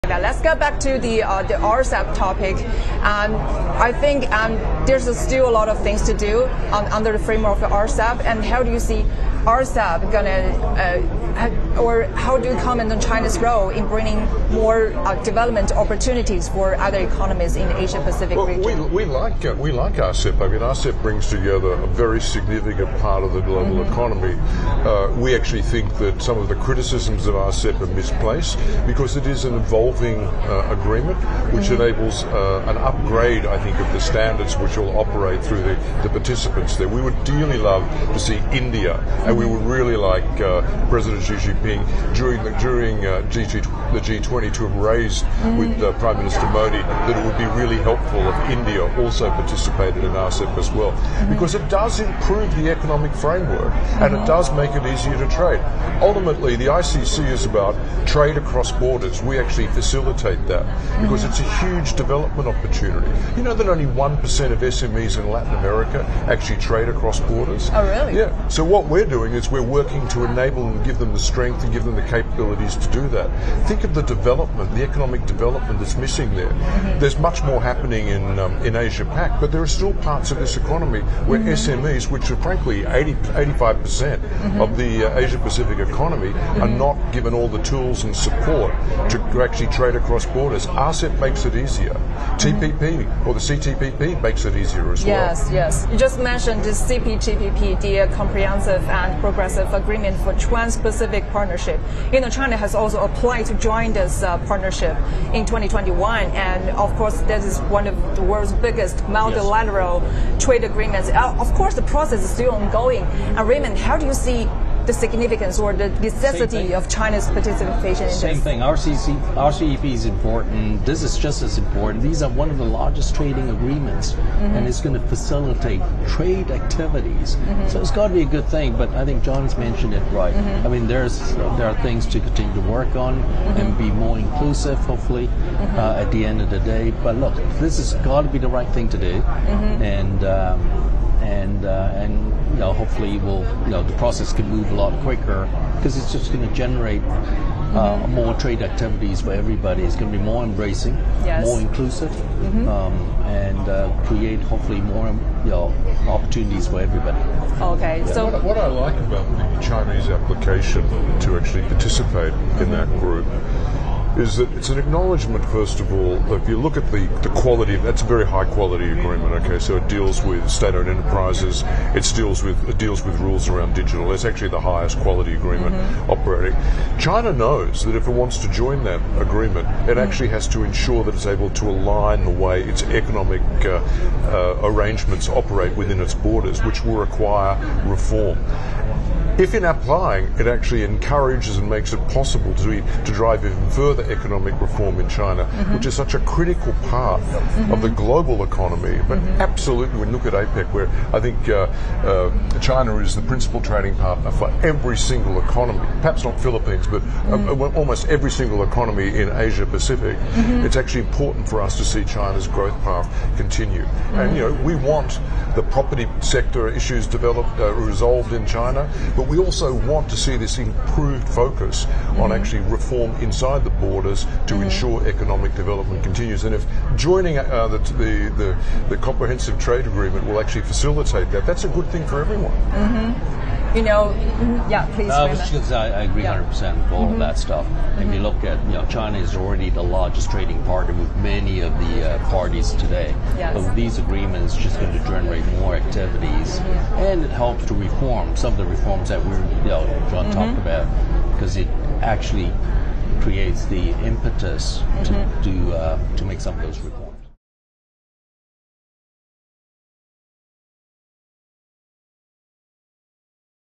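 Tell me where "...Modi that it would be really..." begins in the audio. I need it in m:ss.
0:46.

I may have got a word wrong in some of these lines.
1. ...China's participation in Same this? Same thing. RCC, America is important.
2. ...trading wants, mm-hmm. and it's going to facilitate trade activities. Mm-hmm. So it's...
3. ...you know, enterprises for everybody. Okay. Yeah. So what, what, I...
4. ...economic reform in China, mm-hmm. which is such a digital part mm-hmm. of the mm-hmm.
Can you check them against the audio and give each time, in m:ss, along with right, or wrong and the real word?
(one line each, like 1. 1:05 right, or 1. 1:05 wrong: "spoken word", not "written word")
1. 1:56 wrong: "RCEP", not "America"
2. 2:03 wrong: "agreements", not "wants"
3. 2:35 wrong: "opportunities", not "enterprises"
4. 3:14 wrong: "critical", not "digital".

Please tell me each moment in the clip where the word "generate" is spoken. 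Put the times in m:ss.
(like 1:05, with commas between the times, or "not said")
2:26, 4:05.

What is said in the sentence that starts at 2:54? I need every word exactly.
It's actually the highest quality agreement mm-hmm.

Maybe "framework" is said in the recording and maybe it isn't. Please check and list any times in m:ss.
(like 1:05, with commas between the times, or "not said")
0:07, 0:53.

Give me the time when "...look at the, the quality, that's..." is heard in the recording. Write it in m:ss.
2:46.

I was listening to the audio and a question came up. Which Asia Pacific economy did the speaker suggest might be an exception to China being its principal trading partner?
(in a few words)
Philippines.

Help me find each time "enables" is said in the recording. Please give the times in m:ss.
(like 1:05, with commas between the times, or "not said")
0:31, 1:10.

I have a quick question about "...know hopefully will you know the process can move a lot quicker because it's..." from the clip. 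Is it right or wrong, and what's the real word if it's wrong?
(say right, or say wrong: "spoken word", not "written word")
right.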